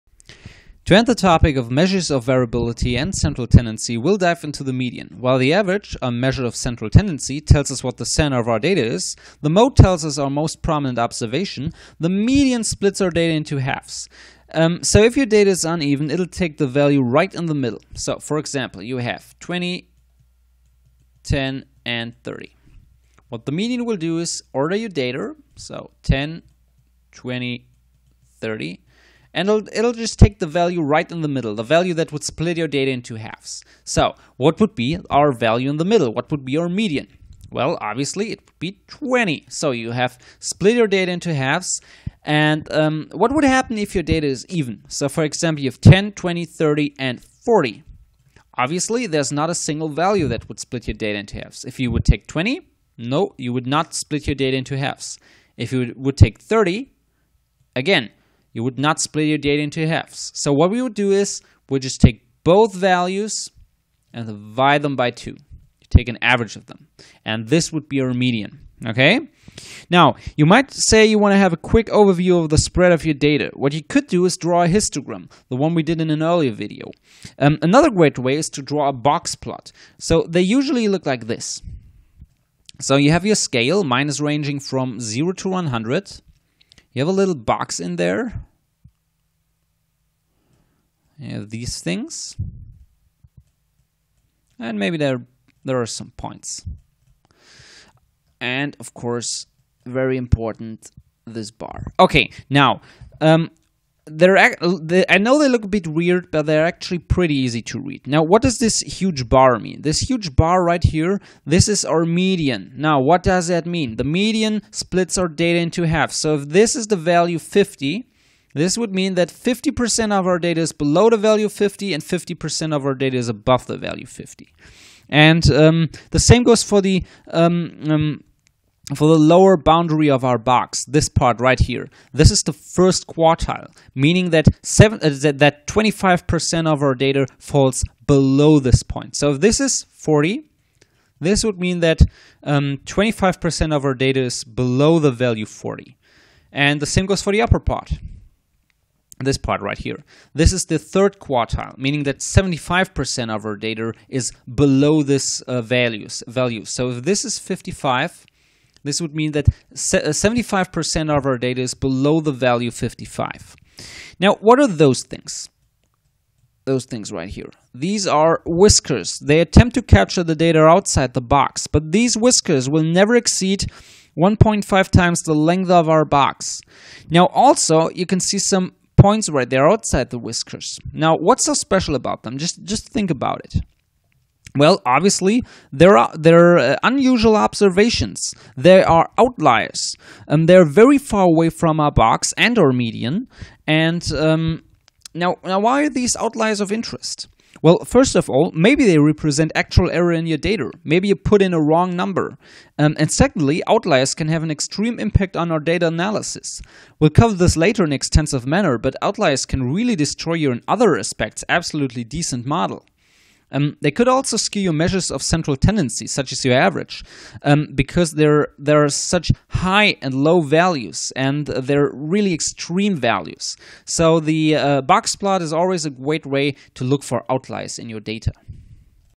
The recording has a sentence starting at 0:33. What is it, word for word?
So what would be our value in the middle?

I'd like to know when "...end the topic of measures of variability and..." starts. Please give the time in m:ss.
0:00.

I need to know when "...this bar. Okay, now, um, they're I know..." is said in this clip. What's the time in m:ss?
1:41.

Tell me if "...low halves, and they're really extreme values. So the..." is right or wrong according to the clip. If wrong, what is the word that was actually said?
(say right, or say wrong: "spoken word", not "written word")
wrong: "values", not "halves".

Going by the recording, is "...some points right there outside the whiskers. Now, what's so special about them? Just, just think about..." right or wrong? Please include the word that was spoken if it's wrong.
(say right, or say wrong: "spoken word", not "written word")
right.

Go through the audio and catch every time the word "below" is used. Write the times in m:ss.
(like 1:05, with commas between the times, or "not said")
2:00, 2:18, 2:24, 2:34, 2:41.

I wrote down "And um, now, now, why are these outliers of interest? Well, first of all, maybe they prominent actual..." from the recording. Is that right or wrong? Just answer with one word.
wrong.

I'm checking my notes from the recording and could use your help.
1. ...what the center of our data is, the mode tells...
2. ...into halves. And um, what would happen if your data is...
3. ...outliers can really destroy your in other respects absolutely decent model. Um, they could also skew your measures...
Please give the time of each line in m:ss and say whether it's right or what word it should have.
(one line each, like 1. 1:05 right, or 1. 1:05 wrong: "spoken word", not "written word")
1. 0:07 right
2. 0:41 right
3. 3:29 right.